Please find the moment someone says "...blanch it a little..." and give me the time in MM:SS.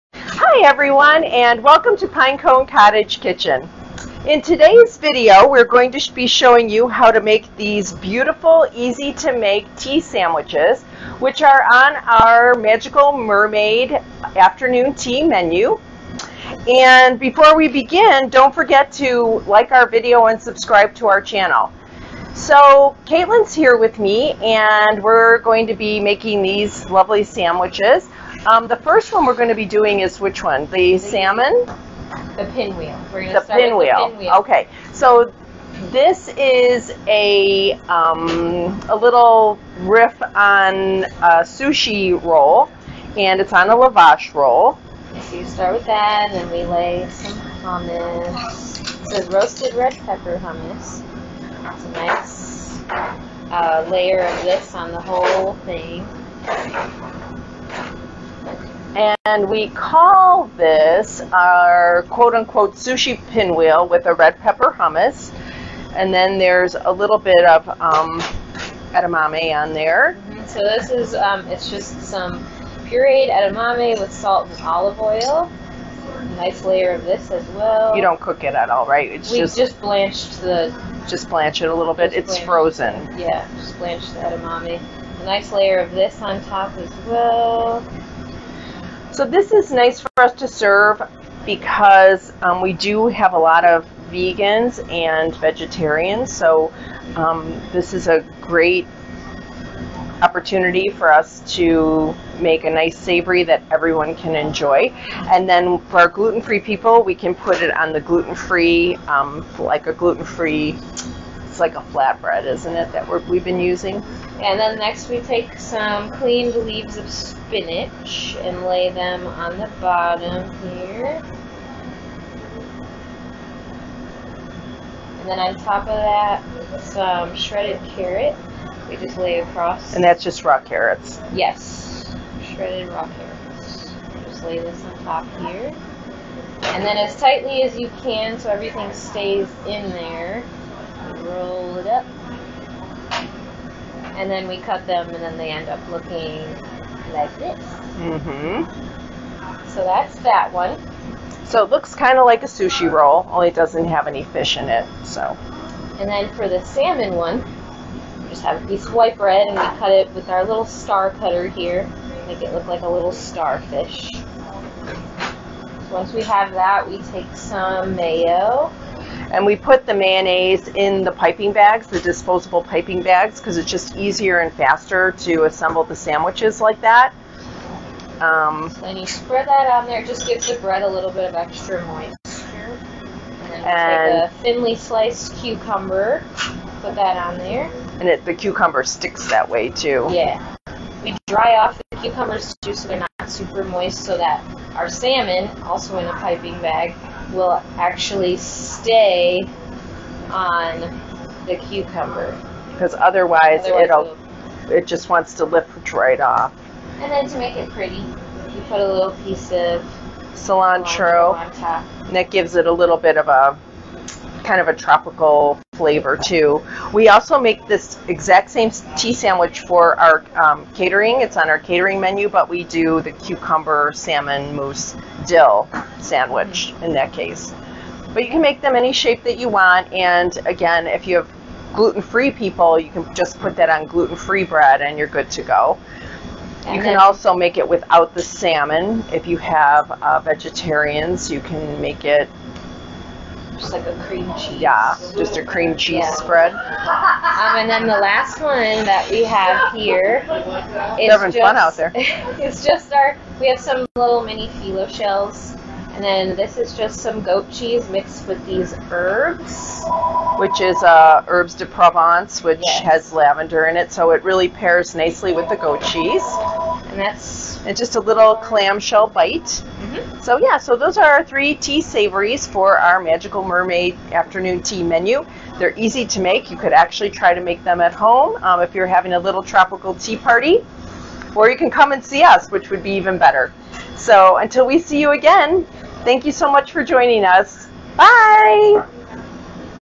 01:21.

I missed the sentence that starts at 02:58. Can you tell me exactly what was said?
Um, and you spread that on there, it just gives the bread a little bit of extra moisture.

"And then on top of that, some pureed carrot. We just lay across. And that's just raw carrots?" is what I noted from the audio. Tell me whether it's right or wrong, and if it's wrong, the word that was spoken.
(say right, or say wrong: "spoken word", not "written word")
wrong: "shredded", not "pureed".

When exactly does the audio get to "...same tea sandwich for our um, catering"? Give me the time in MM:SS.
03:38.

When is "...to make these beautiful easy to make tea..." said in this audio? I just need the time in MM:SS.
00:07.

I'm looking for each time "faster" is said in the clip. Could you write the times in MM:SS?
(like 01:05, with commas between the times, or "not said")
02:54.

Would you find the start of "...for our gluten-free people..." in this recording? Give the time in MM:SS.
01:45.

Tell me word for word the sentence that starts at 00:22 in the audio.
So Kaitlyn's here with me and we're going to be making these lovely sandwiches.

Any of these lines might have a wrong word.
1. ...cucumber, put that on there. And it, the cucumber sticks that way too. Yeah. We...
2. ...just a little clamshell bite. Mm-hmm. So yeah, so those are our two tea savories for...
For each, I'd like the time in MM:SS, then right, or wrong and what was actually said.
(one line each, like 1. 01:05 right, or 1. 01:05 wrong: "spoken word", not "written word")
1. 03:05 right
2. 04:27 wrong: "three", not "two".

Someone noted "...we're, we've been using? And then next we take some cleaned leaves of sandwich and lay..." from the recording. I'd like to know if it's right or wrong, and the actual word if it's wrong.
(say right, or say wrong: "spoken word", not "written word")
wrong: "spinach", not "sandwich".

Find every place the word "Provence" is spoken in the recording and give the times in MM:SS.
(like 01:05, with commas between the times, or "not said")
04:21.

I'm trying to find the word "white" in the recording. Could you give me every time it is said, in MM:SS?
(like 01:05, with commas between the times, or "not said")
02:38.